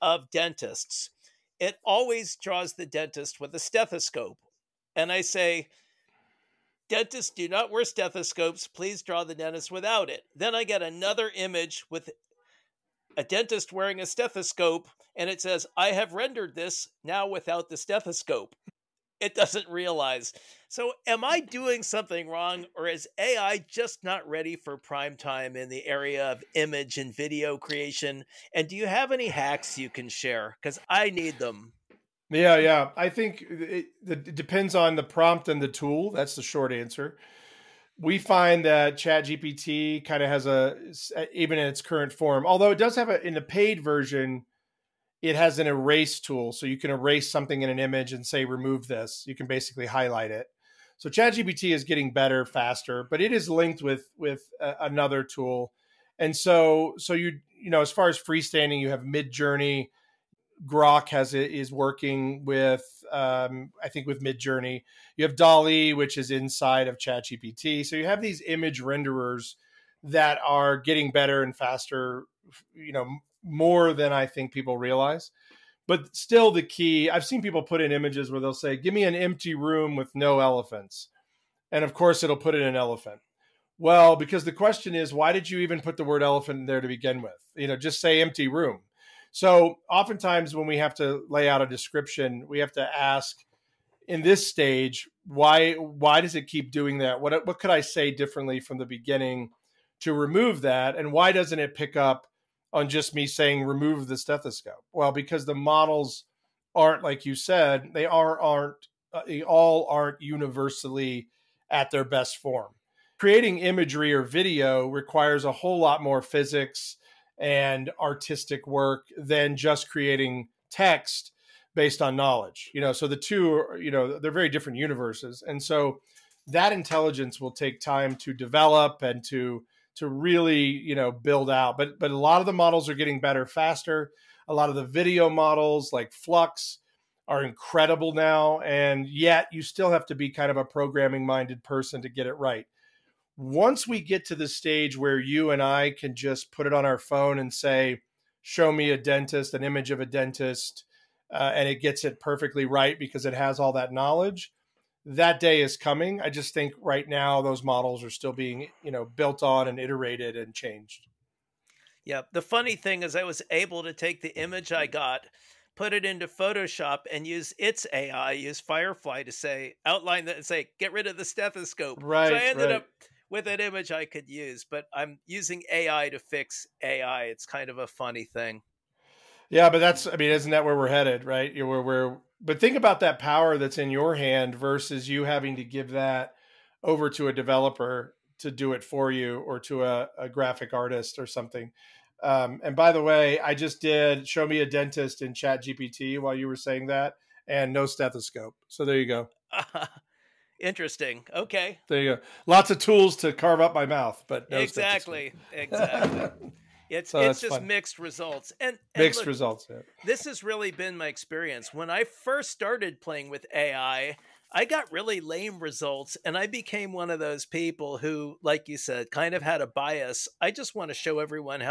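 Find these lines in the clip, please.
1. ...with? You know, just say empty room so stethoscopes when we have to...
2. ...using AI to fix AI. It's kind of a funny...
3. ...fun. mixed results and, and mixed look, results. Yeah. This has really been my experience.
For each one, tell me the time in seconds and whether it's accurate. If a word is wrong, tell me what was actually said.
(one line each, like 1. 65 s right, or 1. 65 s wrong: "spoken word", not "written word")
1. 87 s wrong: "oftentimes", not "stethoscopes"
2. 175 s right
3. 207 s right.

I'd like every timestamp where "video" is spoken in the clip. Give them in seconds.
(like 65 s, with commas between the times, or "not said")
27 s, 114 s, 134 s.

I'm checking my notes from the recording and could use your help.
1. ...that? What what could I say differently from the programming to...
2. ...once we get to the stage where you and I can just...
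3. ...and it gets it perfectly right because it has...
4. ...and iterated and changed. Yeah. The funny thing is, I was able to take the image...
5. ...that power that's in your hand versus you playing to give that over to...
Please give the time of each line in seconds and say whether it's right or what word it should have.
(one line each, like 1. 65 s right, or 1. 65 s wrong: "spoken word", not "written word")
1. 96 s wrong: "beginning", not "programming"
2. 143 s right
3. 151 s right
4. 159 s right
5. 183 s wrong: "having", not "playing".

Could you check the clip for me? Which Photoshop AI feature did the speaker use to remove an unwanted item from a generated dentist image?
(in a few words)
Firefly.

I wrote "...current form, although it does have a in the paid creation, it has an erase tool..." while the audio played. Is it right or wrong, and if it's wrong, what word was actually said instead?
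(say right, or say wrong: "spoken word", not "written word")
wrong: "version", not "creation".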